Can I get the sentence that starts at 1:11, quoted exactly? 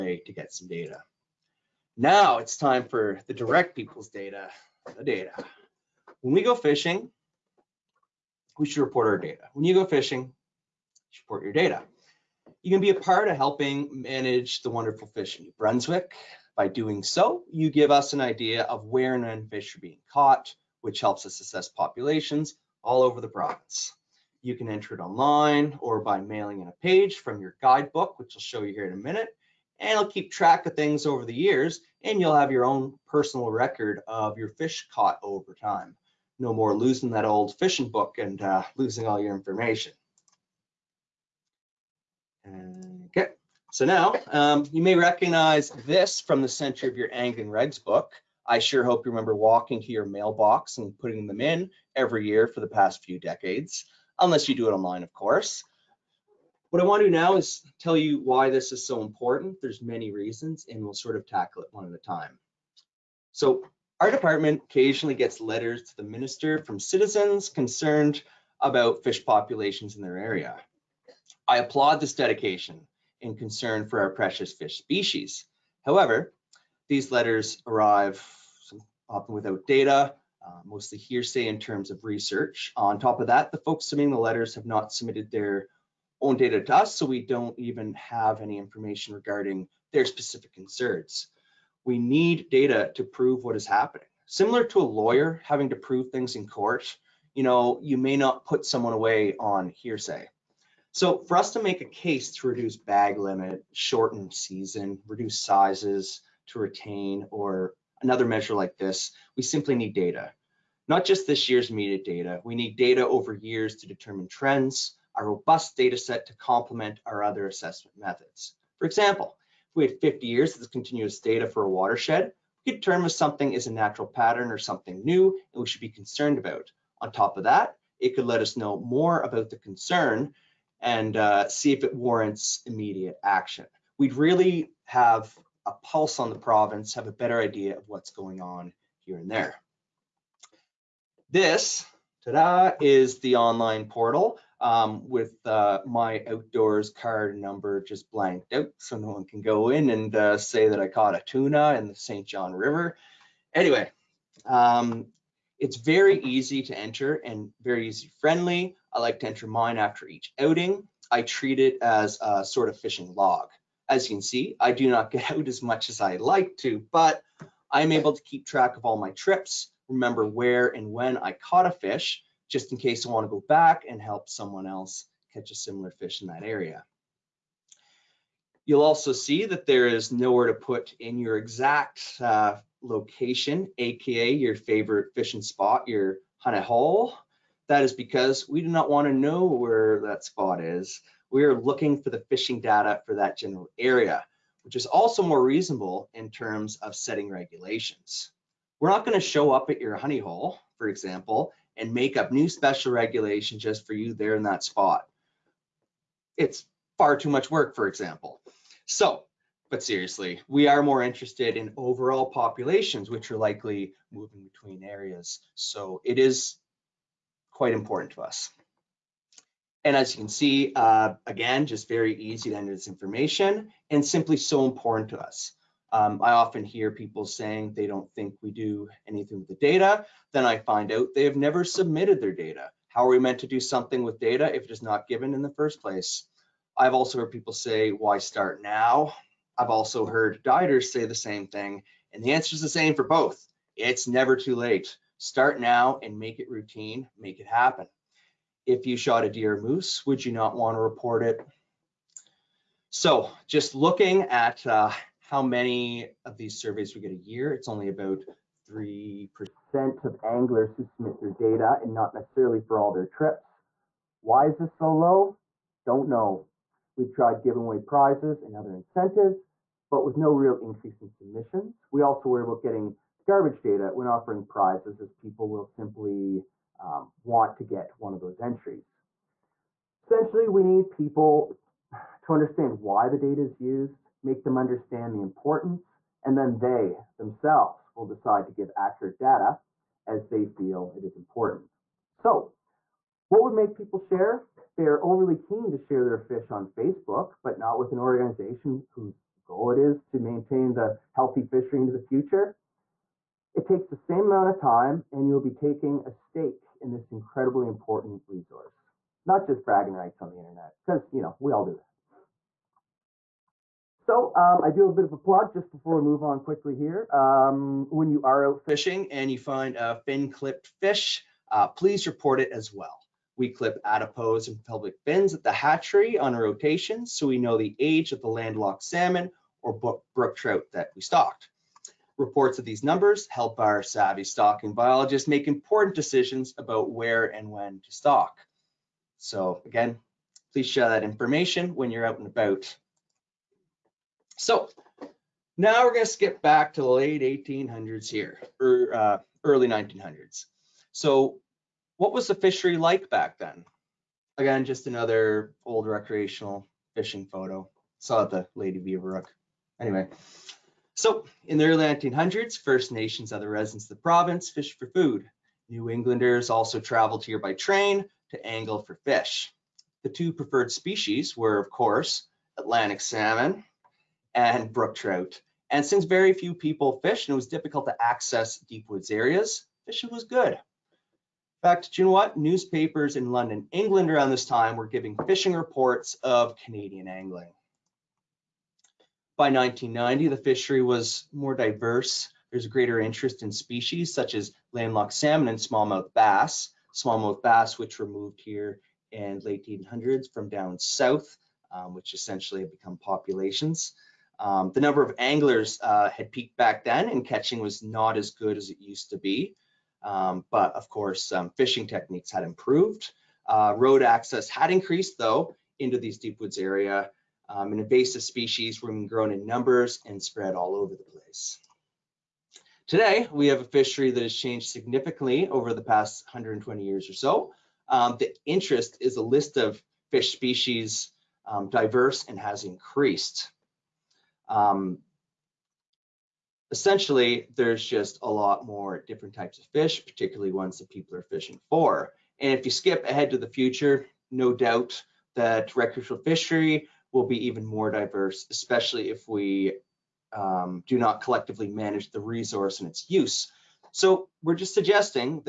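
I applaud this dedication and concern for our precious fish species.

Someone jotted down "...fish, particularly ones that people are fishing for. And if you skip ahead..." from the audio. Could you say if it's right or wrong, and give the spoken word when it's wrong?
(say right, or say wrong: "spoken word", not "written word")
right.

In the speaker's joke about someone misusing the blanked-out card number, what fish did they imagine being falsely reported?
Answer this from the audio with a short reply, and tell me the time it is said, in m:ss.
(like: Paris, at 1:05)
Tuna, at 2:31.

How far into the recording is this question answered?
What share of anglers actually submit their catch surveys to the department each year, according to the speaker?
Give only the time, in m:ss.
4:18.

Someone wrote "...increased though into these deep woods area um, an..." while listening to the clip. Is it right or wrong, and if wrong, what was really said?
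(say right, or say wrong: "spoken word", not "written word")
right.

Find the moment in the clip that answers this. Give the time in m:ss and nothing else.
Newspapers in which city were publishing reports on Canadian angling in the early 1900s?
6:23.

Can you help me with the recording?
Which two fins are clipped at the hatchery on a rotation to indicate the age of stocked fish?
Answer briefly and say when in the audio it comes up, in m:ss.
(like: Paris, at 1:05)
Adipose and pelvic, at 5:23.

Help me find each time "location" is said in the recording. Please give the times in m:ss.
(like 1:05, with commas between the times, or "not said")
3:02.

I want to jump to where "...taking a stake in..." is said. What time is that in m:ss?
5:05.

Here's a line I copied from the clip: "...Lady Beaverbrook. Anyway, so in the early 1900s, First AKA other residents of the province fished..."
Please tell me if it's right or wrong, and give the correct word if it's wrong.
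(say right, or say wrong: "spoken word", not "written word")
wrong: "Nations", not "AKA".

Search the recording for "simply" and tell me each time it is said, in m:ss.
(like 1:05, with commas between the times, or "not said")
1:49, 3:44, 4:35.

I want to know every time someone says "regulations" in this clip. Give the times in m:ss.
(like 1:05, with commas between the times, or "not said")
3:17, 3:22.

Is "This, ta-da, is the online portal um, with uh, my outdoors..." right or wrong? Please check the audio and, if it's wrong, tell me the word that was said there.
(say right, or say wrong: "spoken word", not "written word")
right.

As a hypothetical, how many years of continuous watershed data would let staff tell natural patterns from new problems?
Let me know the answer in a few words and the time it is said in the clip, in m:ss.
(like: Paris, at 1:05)
50, at 2:00.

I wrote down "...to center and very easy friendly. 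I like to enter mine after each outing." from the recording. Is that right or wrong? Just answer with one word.
wrong.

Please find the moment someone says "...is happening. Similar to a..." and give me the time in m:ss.
1:33.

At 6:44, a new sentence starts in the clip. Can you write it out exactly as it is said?
Um, the number of anglers uh, had peaked back then and catching was not as good as it used to be.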